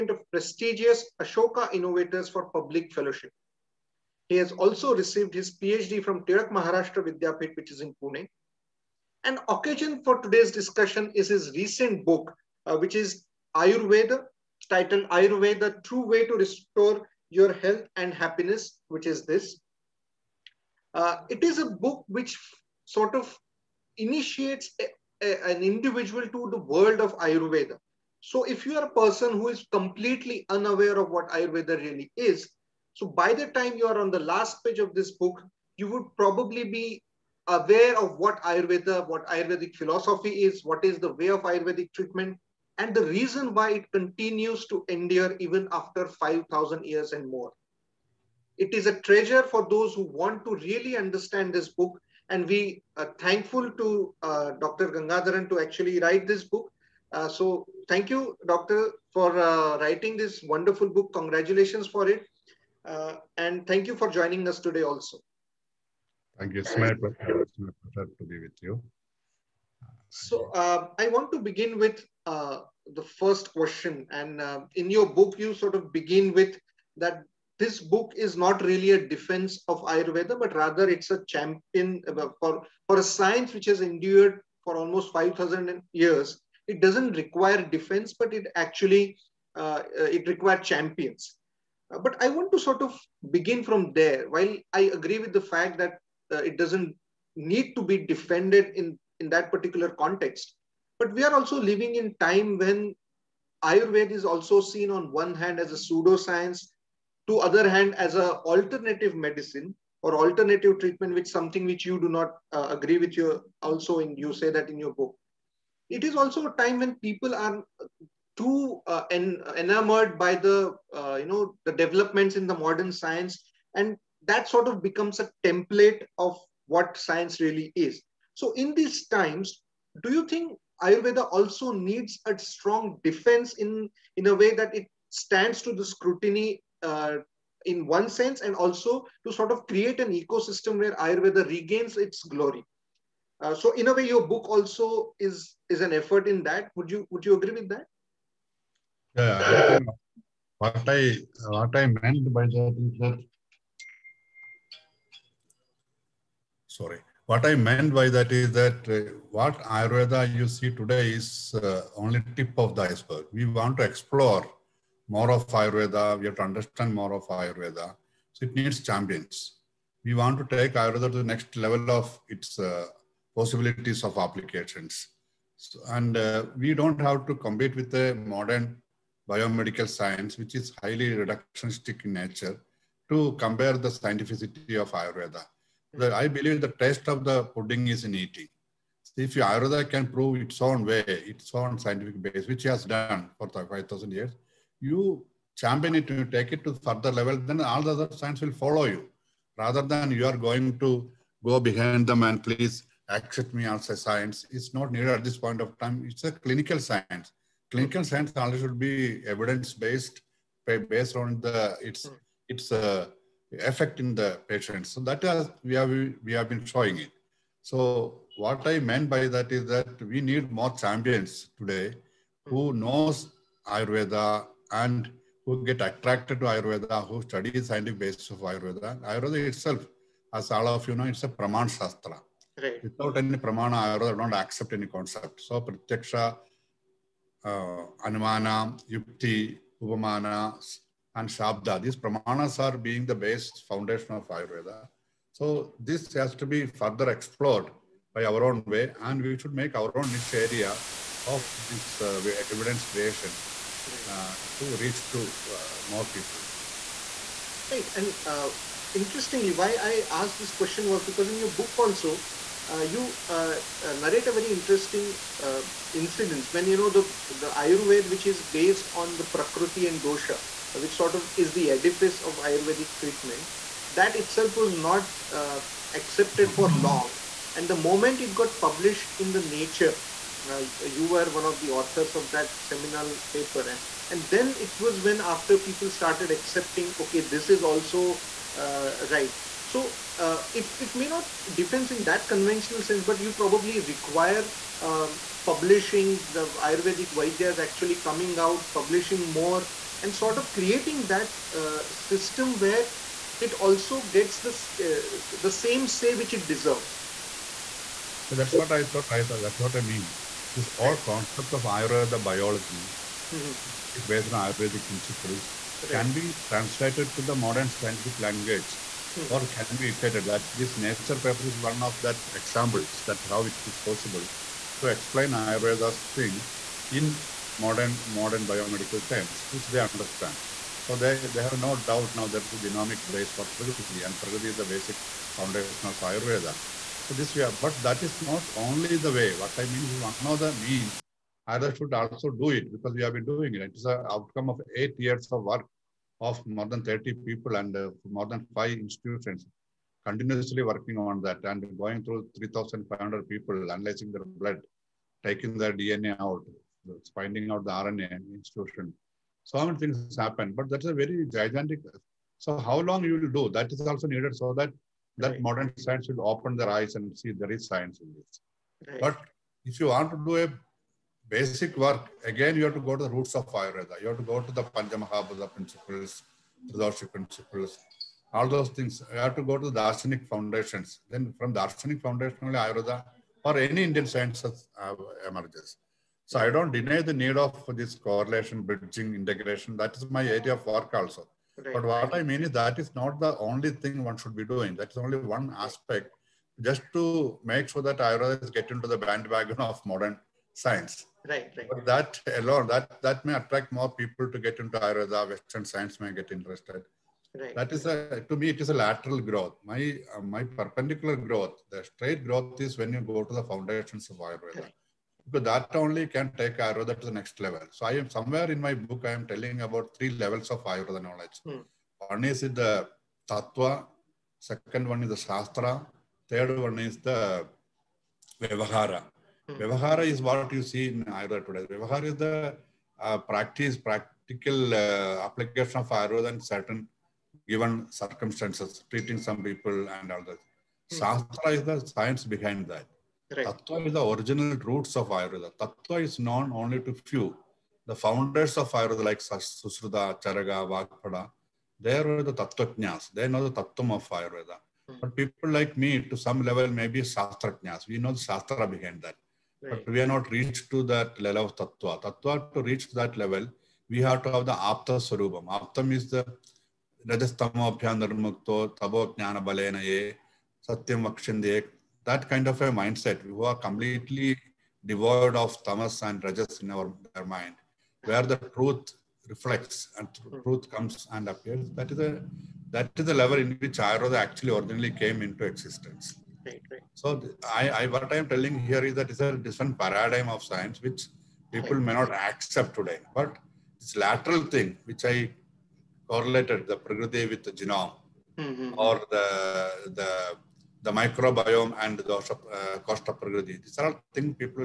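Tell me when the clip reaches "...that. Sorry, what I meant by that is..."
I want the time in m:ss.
2:32.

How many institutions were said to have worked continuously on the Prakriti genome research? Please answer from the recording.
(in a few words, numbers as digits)
more than 5.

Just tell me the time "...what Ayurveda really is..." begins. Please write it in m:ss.
0:31.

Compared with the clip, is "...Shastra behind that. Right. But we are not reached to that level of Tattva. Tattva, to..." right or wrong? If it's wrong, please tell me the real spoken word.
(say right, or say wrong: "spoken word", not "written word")
right.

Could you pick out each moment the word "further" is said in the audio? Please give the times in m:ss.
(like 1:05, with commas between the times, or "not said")
3:16, 4:06.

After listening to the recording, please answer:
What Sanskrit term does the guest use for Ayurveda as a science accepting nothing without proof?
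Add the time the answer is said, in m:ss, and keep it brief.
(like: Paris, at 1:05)
Praman Shastra, at 3:51.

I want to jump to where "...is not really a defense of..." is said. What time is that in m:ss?
1:18.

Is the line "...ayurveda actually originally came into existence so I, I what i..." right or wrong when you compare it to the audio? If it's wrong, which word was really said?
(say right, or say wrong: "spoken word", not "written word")
right.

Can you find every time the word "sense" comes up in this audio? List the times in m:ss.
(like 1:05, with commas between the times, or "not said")
2:18, 4:52.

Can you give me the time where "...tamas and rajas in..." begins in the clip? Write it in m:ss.
7:55.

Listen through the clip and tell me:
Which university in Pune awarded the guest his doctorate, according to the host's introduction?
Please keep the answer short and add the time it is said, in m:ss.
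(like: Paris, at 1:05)
Tilak Maharashtra Vidyapeeth, at 0:06.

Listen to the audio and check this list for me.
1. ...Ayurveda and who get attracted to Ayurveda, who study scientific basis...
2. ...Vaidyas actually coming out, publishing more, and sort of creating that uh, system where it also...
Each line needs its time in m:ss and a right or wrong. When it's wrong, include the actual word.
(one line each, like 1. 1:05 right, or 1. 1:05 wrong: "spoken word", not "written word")
1. 3:43 right
2. 4:57 right.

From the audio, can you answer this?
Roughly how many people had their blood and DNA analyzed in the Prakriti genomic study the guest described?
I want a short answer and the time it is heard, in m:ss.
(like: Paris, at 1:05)
3,500, at 5:52.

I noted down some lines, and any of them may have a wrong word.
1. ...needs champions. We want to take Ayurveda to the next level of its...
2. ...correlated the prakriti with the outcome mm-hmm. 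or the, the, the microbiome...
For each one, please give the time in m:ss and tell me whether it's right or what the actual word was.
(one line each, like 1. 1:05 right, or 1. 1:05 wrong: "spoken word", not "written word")
1. 2:48 right
2. 8:16 wrong: "genome", not "outcome".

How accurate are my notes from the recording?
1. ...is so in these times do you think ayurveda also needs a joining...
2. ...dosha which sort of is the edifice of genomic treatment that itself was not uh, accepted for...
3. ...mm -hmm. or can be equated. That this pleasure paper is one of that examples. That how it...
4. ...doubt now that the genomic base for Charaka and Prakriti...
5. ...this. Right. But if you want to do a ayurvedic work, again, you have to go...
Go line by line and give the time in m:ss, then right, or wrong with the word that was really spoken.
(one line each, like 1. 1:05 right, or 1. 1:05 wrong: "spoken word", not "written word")
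1. 2:07 wrong: "strong", not "joining"
2. 4:30 wrong: "ayurvedic", not "genomic"
3. 5:19 wrong: "nature", not "pleasure"
4. 5:31 wrong: "Prakriti", not "Charaka"
5. 6:08 wrong: "basic", not "ayurvedic".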